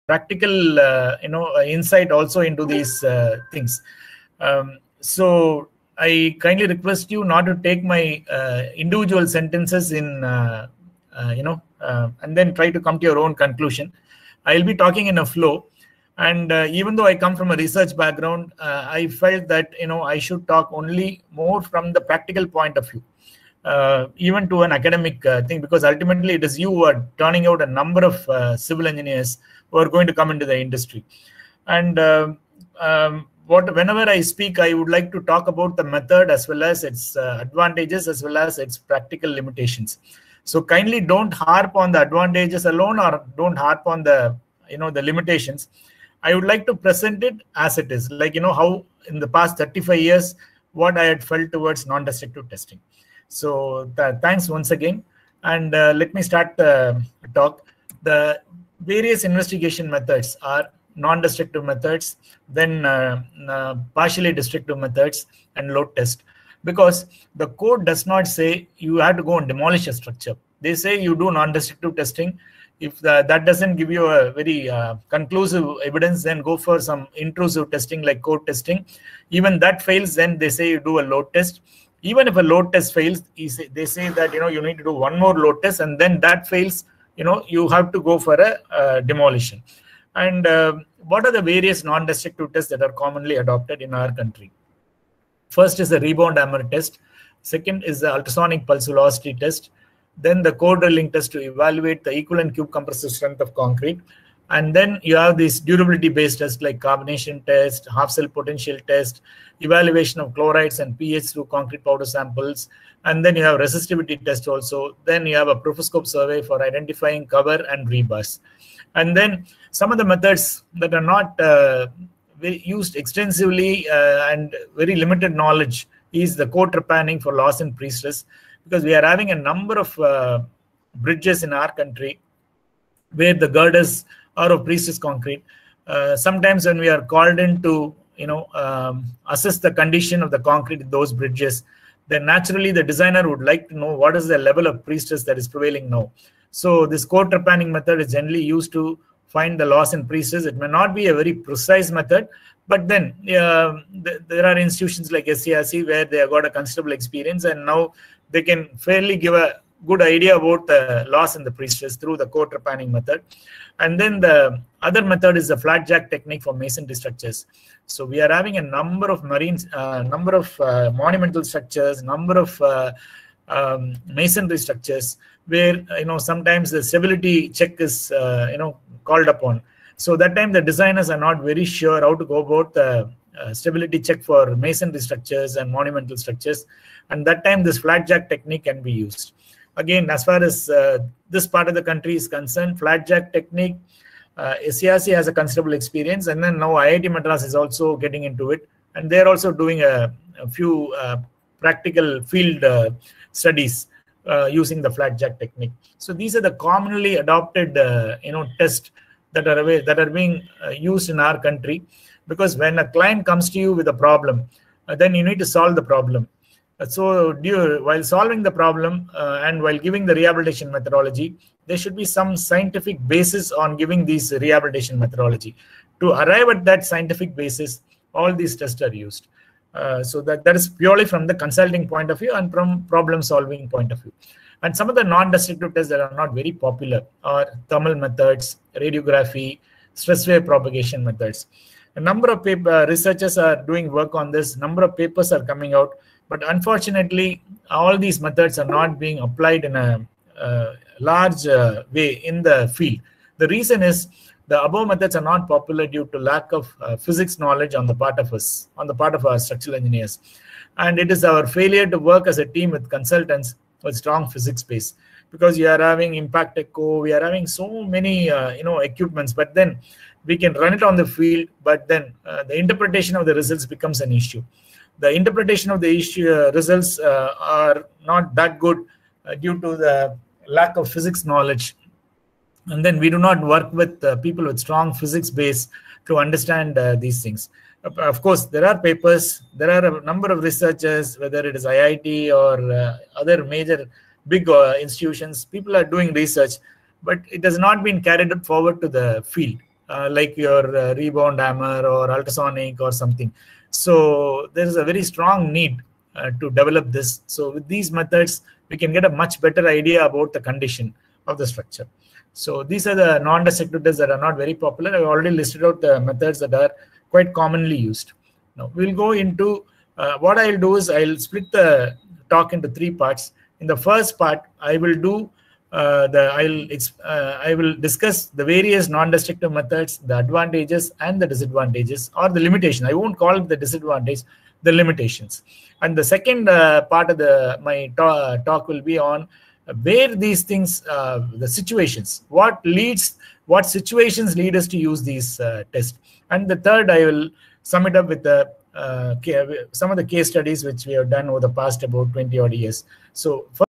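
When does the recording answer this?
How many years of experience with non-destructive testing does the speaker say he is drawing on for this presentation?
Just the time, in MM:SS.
00:49.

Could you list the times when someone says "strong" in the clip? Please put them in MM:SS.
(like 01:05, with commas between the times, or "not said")
04:23, 04:44, 05:05.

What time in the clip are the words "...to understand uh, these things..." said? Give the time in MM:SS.
04:46.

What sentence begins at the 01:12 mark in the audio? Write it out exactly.
If that doesn't give you a very uh, conclusive evidence, then go for some intrusive testing like core testing.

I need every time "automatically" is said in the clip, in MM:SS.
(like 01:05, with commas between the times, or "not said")
not said.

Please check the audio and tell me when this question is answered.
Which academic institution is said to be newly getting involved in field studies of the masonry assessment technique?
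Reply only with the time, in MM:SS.
03:16.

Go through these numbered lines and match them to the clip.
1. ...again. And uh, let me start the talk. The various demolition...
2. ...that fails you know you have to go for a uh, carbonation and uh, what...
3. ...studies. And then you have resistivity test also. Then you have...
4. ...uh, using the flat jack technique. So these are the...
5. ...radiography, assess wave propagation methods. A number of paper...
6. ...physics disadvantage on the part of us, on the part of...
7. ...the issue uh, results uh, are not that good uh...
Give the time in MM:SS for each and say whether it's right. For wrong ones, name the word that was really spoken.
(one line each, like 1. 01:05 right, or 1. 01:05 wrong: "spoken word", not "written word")
1. 00:54 wrong: "investigation", not "demolition"
2. 01:26 wrong: "demolition", not "carbonation"
3. 01:52 wrong: "samples", not "studies"
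4. 03:24 right
5. 03:58 wrong: "stress", not "assess"
6. 04:16 wrong: "knowledge", not "disadvantage"
7. 04:35 right.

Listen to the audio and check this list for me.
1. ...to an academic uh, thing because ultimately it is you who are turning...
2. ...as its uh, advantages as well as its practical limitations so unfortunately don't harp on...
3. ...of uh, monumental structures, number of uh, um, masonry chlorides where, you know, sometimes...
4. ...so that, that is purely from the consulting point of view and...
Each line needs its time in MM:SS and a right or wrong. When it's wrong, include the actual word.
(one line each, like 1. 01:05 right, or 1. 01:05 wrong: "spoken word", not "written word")
1. 00:24 right
2. 00:36 wrong: "kindly", not "unfortunately"
3. 02:50 wrong: "structures", not "chlorides"
4. 03:50 right.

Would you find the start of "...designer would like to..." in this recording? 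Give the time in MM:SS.
02:22.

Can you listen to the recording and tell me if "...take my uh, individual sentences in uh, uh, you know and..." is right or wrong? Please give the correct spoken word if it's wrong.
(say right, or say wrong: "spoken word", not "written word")
right.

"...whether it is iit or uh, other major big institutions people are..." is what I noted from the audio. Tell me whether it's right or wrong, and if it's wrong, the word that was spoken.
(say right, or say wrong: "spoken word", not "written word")
right.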